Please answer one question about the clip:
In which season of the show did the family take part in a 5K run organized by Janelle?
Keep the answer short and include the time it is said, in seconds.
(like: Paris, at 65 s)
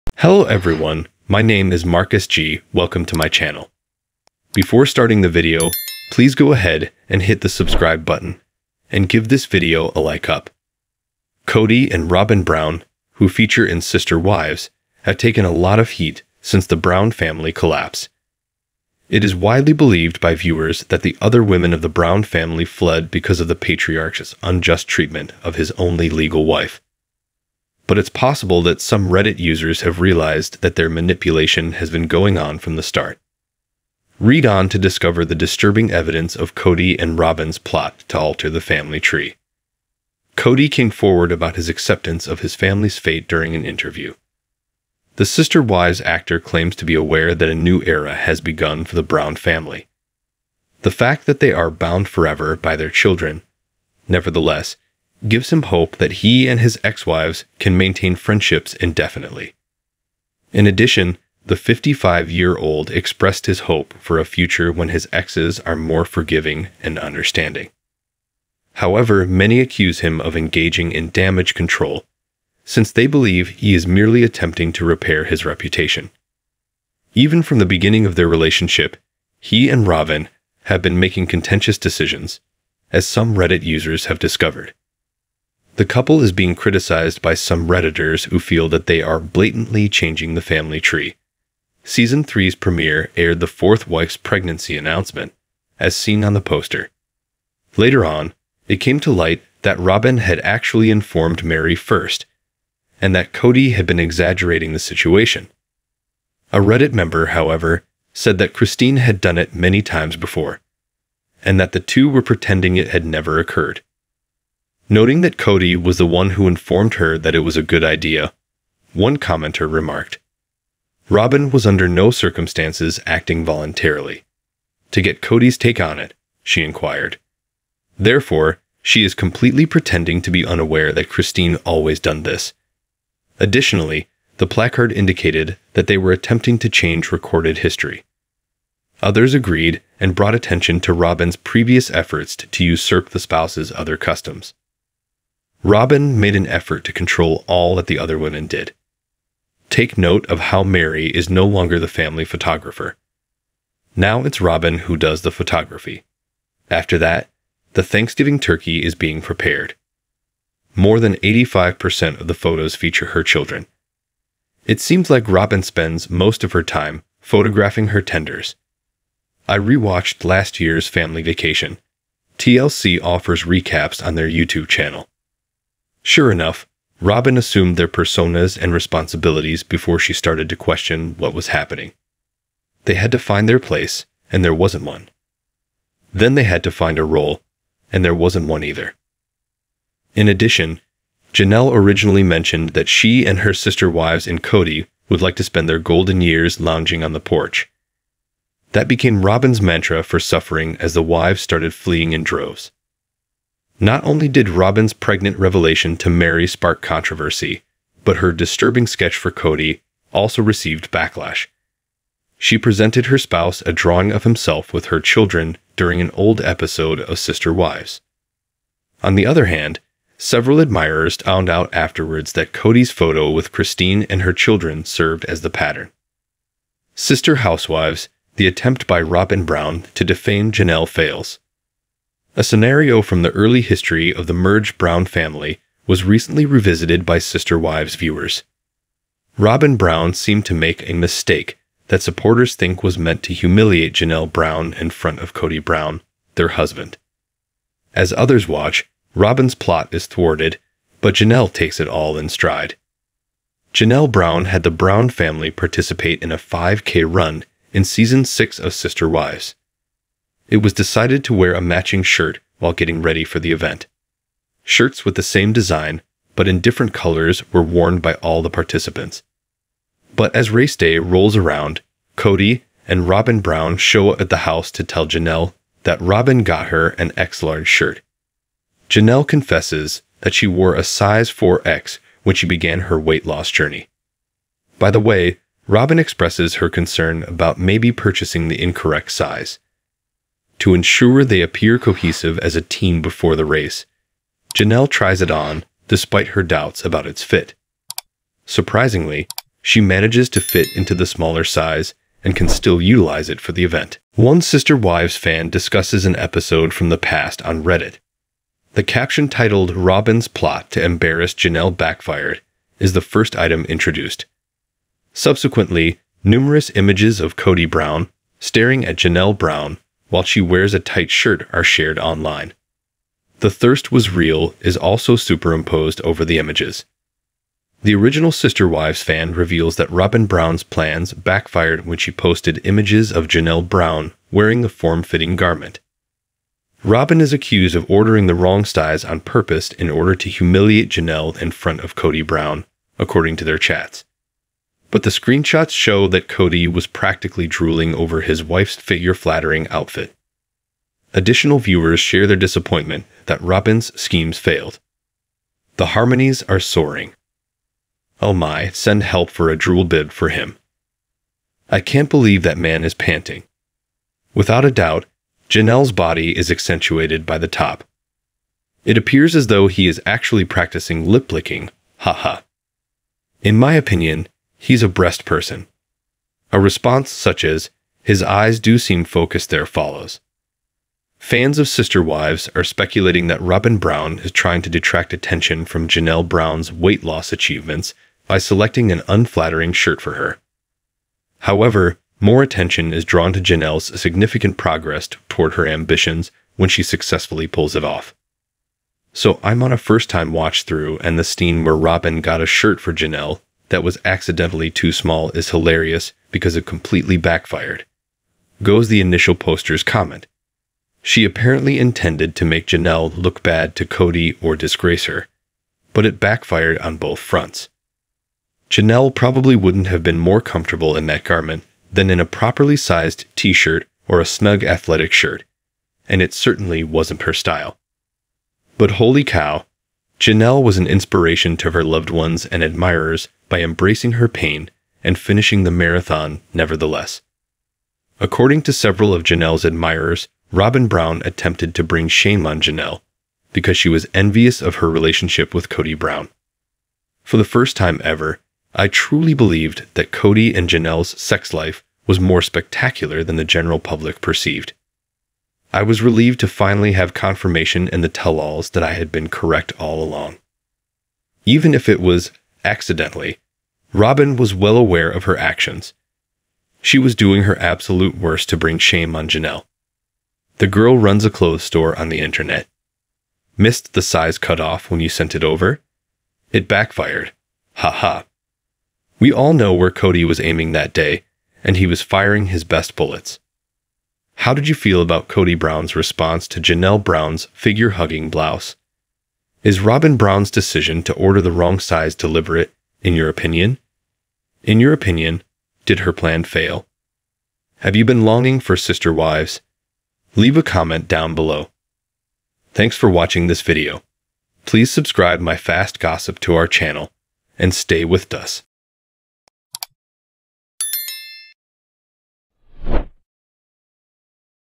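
Season 6, at 257 s.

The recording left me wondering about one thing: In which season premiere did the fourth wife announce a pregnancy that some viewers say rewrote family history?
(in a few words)
Season 3.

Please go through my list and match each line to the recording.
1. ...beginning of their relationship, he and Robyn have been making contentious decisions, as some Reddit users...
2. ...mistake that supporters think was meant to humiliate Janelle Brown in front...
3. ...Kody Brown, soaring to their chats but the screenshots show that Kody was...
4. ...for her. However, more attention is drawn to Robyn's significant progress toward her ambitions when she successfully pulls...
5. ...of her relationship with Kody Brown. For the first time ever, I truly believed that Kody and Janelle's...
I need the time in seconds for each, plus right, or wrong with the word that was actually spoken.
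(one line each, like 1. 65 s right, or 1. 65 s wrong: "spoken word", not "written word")
1. 77 s right
2. 240 s right
3. 341 s wrong: "according", not "soaring"
4. 389 s wrong: "Janelle", not "Robyn"
5. 444 s right.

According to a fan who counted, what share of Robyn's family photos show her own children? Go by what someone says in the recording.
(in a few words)
More than 85%.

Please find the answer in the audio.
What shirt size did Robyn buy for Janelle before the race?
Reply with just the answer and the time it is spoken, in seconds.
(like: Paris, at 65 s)
X large, at 277 s.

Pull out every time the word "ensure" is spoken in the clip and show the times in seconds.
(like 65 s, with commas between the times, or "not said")
290 s.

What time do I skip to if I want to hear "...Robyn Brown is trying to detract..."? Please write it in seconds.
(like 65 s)
383 s.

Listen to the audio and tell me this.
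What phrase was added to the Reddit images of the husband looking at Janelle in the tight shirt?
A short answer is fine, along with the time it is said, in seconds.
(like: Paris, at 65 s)
The Thirst Was Real, at 323 s.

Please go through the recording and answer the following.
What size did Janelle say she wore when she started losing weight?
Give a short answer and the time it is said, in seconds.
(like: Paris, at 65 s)
4X, at 281 s.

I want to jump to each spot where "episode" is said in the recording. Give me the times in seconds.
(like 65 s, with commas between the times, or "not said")
216 s, 306 s.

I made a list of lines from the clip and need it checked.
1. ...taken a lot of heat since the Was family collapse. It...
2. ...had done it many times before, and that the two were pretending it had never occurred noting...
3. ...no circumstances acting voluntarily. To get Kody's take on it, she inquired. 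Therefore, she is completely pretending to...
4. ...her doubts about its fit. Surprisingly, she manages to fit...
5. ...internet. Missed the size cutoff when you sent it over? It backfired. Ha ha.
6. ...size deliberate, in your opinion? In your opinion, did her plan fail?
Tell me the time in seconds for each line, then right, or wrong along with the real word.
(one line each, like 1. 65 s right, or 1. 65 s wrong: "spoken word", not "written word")
1. 15 s wrong: "Brown", not "Was"
2. 108 s right
3. 121 s right
4. 296 s right
5. 472 s right
6. 491 s right.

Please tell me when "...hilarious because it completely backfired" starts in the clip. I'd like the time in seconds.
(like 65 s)
405 s.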